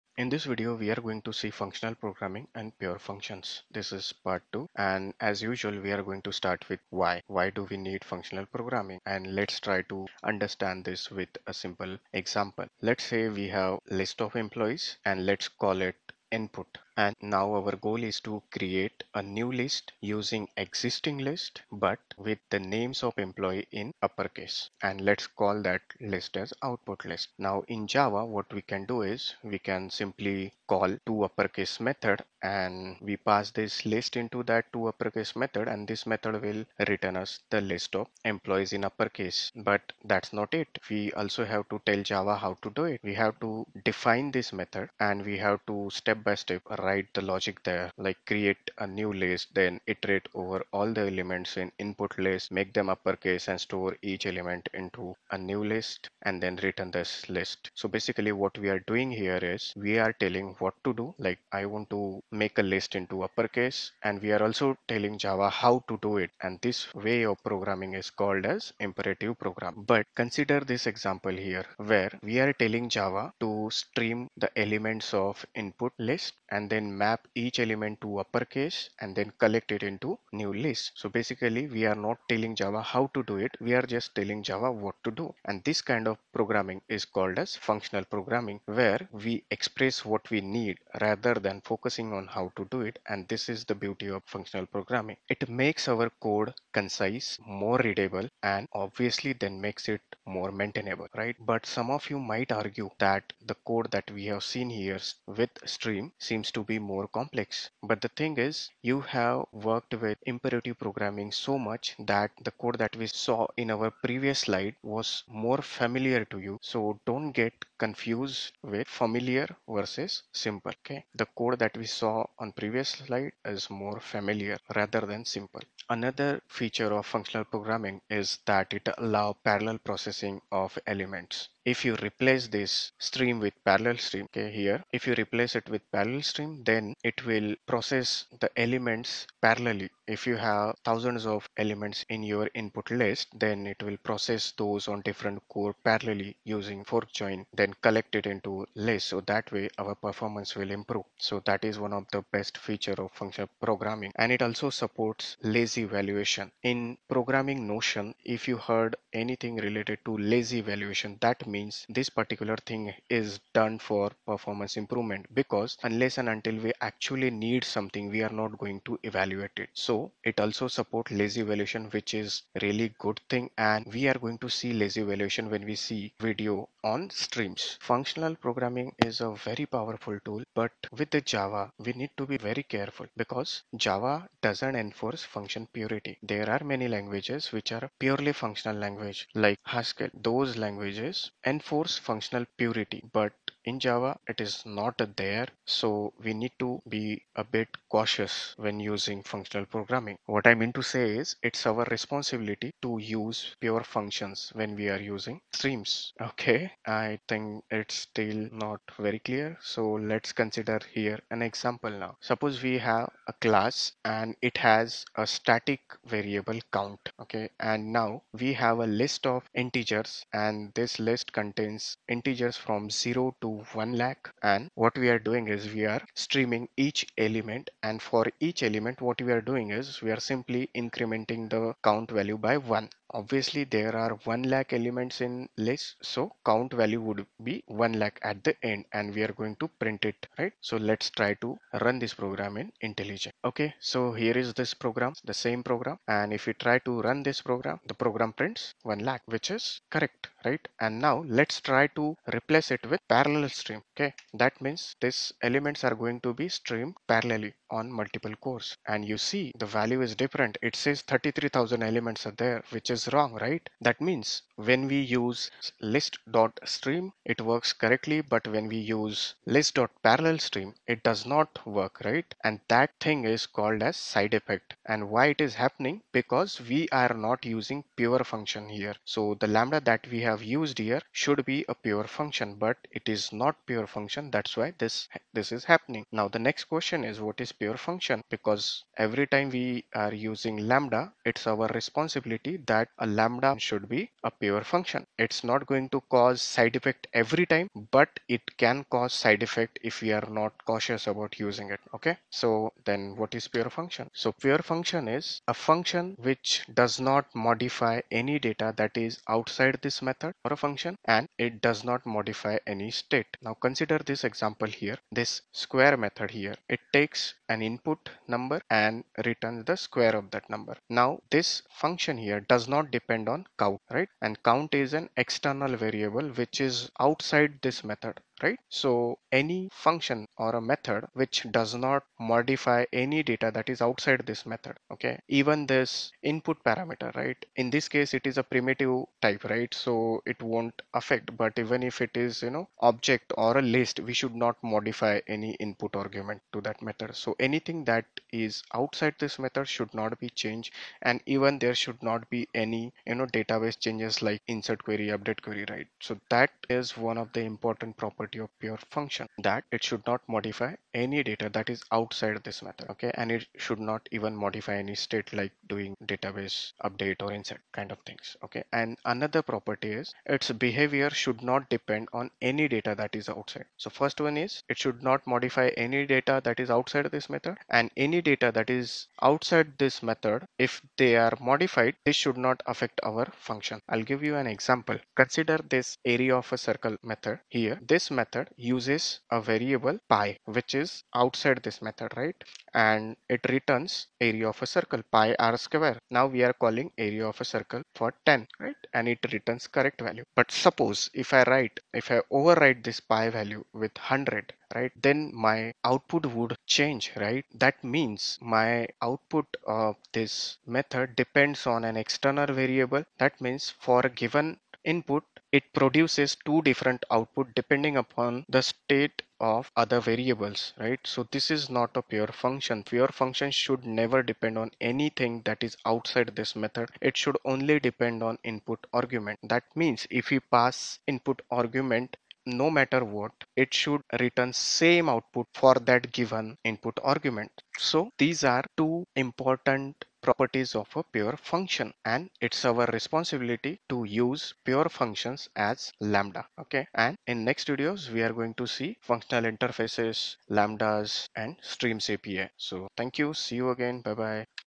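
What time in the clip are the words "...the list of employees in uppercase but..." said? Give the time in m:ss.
0:37.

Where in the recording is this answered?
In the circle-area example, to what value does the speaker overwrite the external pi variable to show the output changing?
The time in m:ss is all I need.
6:43.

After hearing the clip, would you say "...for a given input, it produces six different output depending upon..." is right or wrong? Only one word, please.
wrong.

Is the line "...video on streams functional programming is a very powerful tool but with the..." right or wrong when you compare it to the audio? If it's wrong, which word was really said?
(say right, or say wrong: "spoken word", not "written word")
right.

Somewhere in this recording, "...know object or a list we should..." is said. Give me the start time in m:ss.
5:42.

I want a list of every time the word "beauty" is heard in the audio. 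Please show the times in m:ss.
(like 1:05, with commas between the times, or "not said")
1:33.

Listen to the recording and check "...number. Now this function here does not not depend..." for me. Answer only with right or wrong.
right.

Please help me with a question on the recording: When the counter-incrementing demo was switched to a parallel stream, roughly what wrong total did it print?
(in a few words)
33,000.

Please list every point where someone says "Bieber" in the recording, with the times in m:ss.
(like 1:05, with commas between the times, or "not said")
not said.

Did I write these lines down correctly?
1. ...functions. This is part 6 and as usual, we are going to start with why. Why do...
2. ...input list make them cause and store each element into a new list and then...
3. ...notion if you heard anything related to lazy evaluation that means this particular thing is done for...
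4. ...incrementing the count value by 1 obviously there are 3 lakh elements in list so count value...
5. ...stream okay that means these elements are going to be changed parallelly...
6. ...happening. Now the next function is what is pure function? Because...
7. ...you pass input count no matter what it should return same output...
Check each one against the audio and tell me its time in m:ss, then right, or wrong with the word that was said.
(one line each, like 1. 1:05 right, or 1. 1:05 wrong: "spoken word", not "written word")
1. 0:02 wrong: "2", not "6"
2. 0:51 wrong: "uppercase", not "cause"
3. 2:37 right
4. 3:50 wrong: "1", not "3"
5. 4:13 wrong: "streamed", not "changed"
6. 4:45 wrong: "question", not "function"
7. 7:10 wrong: "argument", not "count".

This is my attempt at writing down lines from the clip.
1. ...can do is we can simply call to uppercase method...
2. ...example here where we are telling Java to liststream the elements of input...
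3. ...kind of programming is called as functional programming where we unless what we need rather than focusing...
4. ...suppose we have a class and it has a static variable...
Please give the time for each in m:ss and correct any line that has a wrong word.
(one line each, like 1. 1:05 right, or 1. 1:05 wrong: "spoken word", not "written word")
1. 0:28 right
2. 1:10 wrong: "stream", not "liststream"
3. 1:25 wrong: "express", not "unless"
4. 3:32 right.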